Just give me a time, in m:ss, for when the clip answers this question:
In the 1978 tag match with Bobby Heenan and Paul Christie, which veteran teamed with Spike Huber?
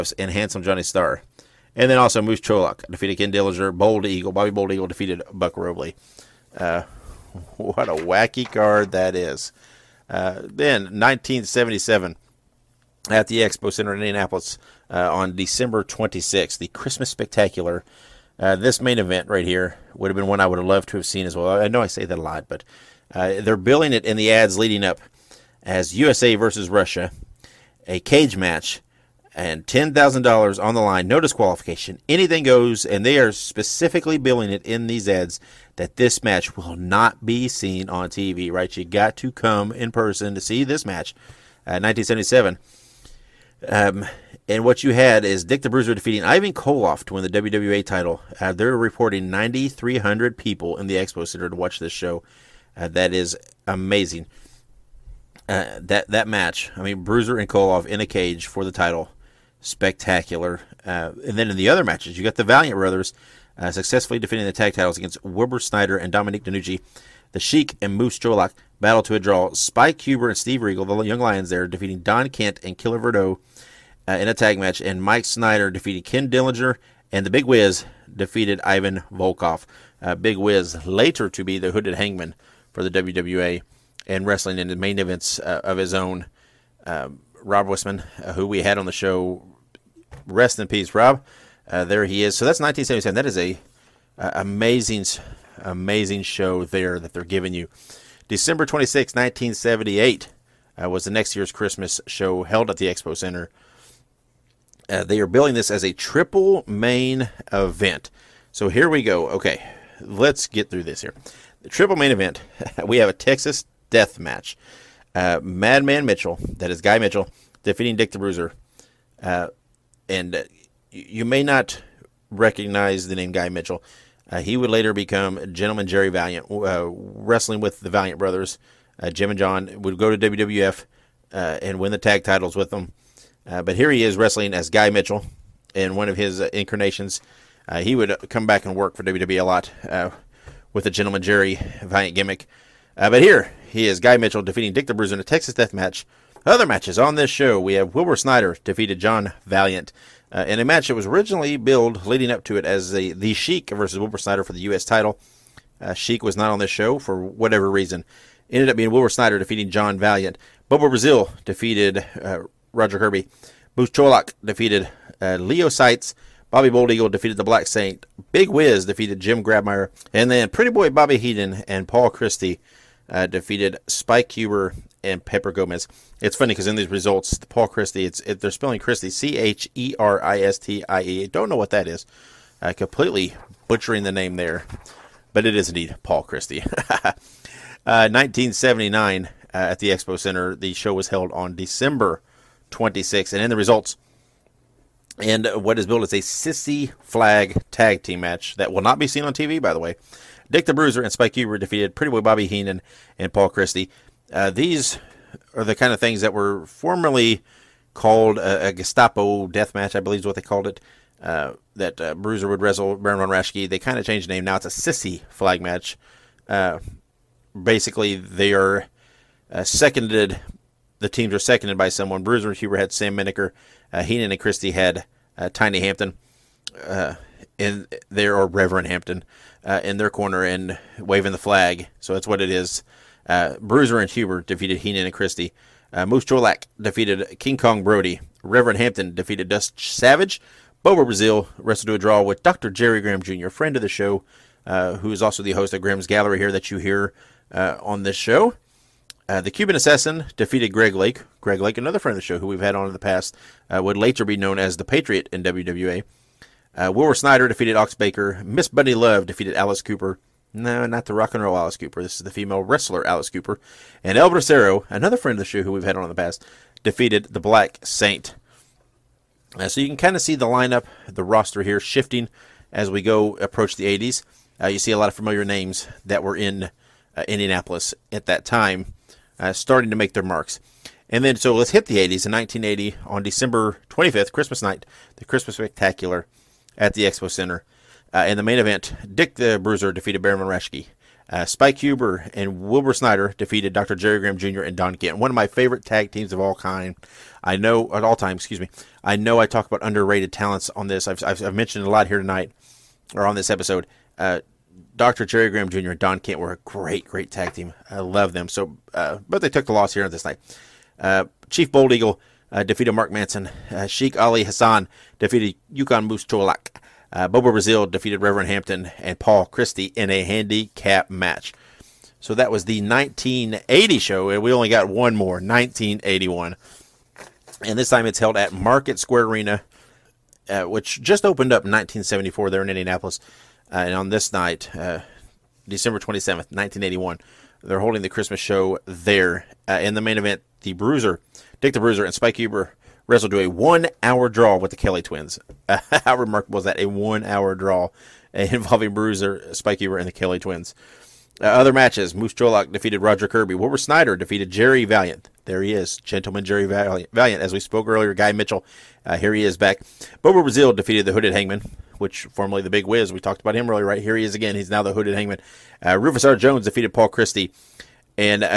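2:55.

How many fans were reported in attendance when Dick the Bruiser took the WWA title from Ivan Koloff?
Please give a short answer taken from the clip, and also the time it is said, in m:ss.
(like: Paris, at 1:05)
9,300, at 0:49.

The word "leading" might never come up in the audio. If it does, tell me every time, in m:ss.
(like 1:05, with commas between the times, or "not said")
0:24, 2:32.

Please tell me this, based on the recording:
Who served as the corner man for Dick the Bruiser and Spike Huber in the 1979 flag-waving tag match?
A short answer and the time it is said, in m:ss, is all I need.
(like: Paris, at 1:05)
Sam Menacker, at 3:42.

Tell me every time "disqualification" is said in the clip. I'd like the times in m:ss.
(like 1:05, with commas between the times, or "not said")
0:31.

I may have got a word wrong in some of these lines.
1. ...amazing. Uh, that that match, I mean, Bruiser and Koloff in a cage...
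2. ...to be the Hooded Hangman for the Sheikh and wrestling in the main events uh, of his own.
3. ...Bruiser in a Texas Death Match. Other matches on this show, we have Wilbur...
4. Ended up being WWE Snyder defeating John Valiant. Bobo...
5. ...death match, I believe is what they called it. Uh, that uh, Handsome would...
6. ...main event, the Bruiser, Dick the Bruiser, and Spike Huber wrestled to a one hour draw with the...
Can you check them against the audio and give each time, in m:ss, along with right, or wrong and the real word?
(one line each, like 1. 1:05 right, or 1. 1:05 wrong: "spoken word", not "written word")
1. 0:53 right
2. 1:21 wrong: "WWA", not "Sheikh"
3. 2:24 right
4. 2:38 wrong: "Wilbur", not "WWE"
5. 3:29 wrong: "Bruiser", not "Handsome"
6. 5:40 right.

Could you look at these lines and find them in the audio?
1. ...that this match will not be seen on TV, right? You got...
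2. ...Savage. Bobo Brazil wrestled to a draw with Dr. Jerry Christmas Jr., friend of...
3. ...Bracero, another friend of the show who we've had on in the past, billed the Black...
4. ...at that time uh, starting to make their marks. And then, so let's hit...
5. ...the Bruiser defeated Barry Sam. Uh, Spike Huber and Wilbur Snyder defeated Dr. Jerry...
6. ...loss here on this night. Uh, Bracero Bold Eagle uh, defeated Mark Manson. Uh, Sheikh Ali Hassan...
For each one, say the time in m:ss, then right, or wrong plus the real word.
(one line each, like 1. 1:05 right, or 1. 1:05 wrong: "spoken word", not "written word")
1. 0:35 right
2. 3:59 wrong: "Graham", not "Christmas"
3. 4:24 wrong: "defeated", not "billed"
4. 4:38 right
5. 4:49 wrong: "Rashke", not "Sam"
6. 5:09 wrong: "Chief", not "Bracero".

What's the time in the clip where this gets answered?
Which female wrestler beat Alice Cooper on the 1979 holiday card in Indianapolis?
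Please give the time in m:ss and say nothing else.
4:18.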